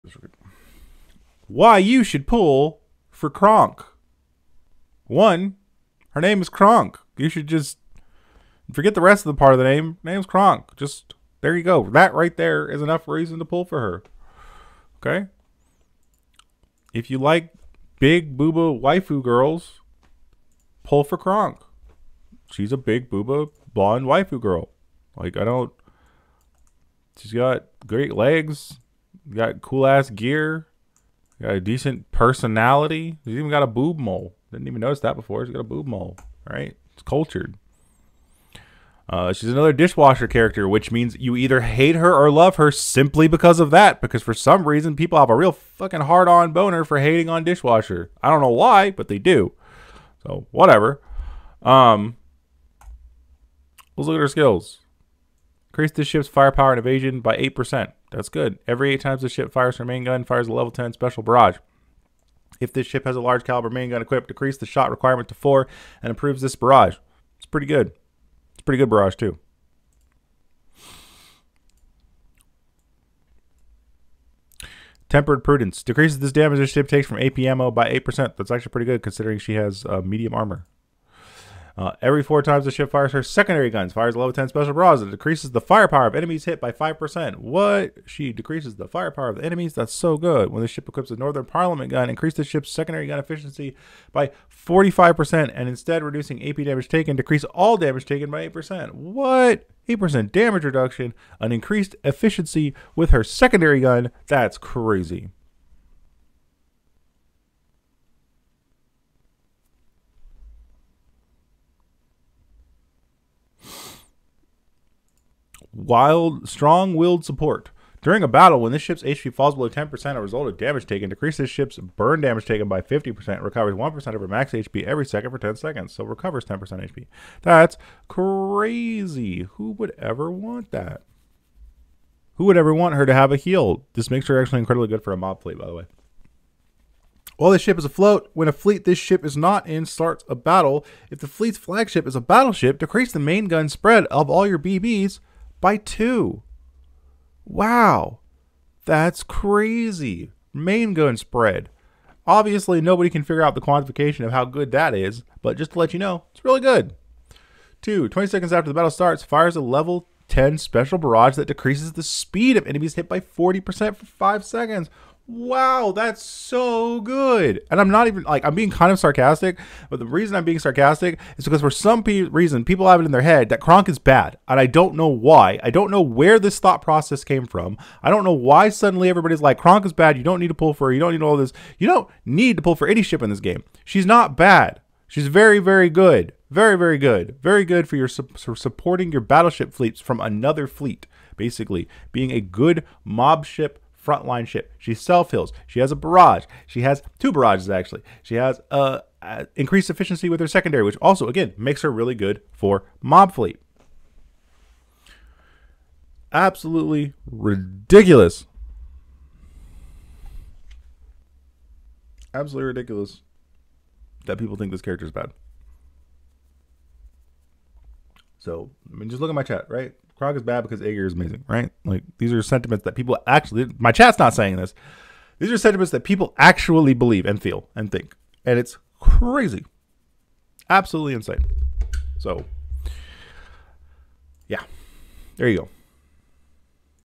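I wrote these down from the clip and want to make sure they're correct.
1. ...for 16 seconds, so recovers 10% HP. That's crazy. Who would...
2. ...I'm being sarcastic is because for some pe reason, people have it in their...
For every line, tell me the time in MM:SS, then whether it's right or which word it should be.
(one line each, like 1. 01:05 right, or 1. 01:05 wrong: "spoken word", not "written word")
1. 02:05 wrong: "10", not "16"
2. 02:50 right.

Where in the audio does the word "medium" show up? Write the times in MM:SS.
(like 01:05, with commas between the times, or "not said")
01:20.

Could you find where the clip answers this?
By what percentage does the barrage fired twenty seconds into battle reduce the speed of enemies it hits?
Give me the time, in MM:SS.
02:43.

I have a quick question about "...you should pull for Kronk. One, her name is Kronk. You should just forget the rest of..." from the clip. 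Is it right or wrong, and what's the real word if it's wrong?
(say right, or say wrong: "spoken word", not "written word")
right.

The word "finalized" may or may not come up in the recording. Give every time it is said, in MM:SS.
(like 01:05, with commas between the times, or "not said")
not said.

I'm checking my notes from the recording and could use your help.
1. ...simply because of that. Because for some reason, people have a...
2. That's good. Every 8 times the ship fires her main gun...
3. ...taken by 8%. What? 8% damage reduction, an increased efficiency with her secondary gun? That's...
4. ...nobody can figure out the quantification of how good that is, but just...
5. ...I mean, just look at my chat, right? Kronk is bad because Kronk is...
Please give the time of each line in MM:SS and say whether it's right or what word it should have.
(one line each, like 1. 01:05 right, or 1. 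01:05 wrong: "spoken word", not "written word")
1. 00:42 right
2. 00:58 right
3. 01:38 right
4. 02:32 right
5. 03:38 wrong: "Agir", not "Kronk".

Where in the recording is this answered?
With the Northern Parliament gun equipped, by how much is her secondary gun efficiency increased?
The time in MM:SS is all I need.
01:34.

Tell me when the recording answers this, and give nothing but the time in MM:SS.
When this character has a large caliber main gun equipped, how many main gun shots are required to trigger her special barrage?
01:04.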